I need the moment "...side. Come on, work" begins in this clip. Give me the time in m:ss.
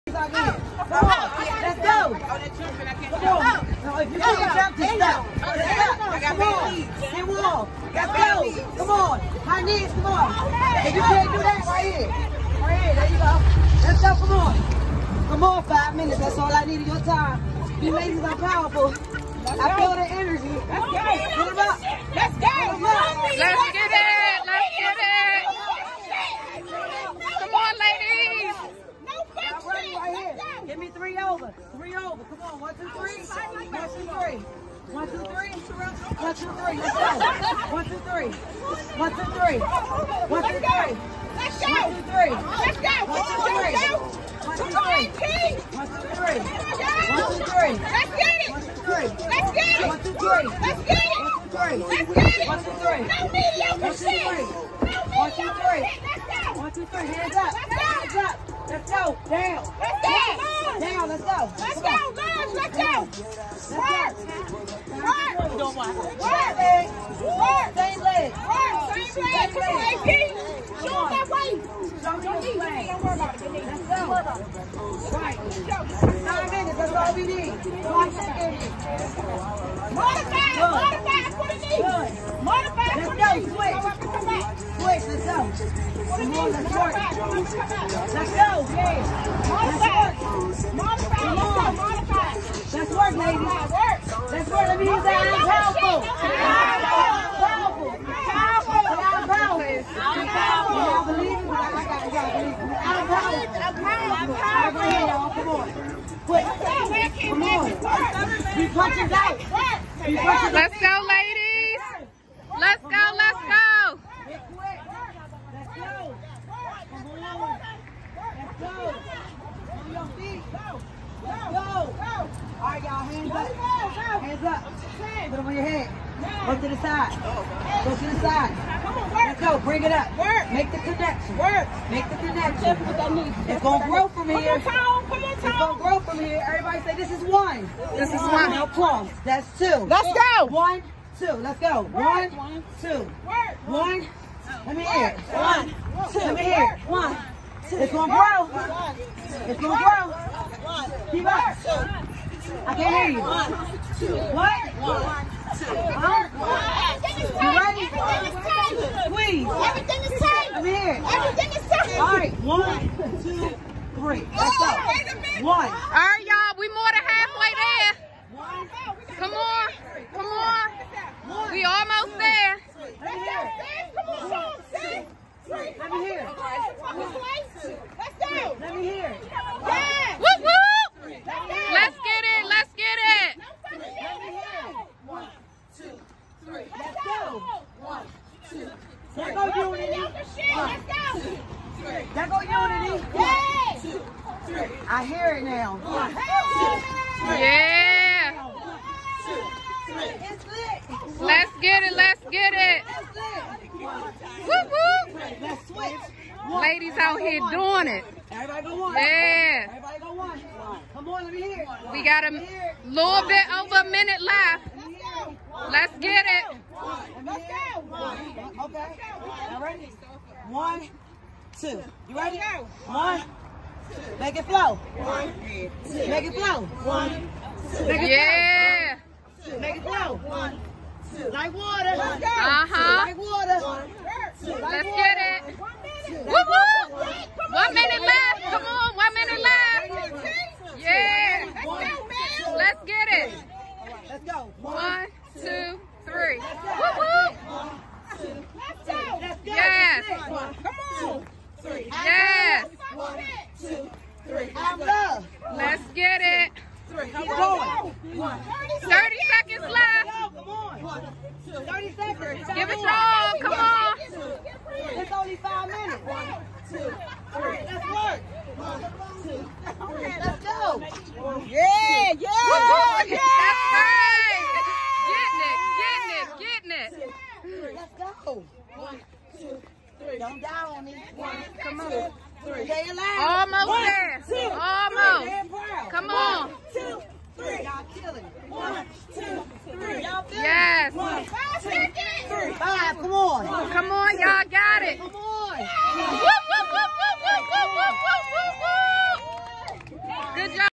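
2:08.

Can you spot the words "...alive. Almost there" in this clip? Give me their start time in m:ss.
4:42.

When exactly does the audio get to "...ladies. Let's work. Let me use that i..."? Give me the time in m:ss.
1:33.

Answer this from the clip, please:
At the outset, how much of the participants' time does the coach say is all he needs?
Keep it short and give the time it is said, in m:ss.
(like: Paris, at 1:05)
5 minutes, at 0:15.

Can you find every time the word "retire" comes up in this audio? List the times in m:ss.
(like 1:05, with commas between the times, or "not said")
not said.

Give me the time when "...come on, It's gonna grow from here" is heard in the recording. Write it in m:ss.
2:15.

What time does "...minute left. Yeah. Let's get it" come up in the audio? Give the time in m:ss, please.
3:59.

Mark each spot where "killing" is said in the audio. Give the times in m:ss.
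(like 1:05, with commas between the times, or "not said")
4:47.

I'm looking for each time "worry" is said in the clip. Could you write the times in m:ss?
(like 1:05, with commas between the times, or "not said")
1:12.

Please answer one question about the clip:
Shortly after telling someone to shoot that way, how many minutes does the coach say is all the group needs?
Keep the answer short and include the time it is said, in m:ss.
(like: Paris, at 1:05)
9 minutes, at 1:16.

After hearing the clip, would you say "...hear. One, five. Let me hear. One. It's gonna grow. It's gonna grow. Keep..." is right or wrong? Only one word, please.
wrong.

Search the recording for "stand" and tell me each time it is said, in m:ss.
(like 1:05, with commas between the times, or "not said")
not said.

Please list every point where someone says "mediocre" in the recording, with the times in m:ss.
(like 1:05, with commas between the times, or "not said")
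0:53.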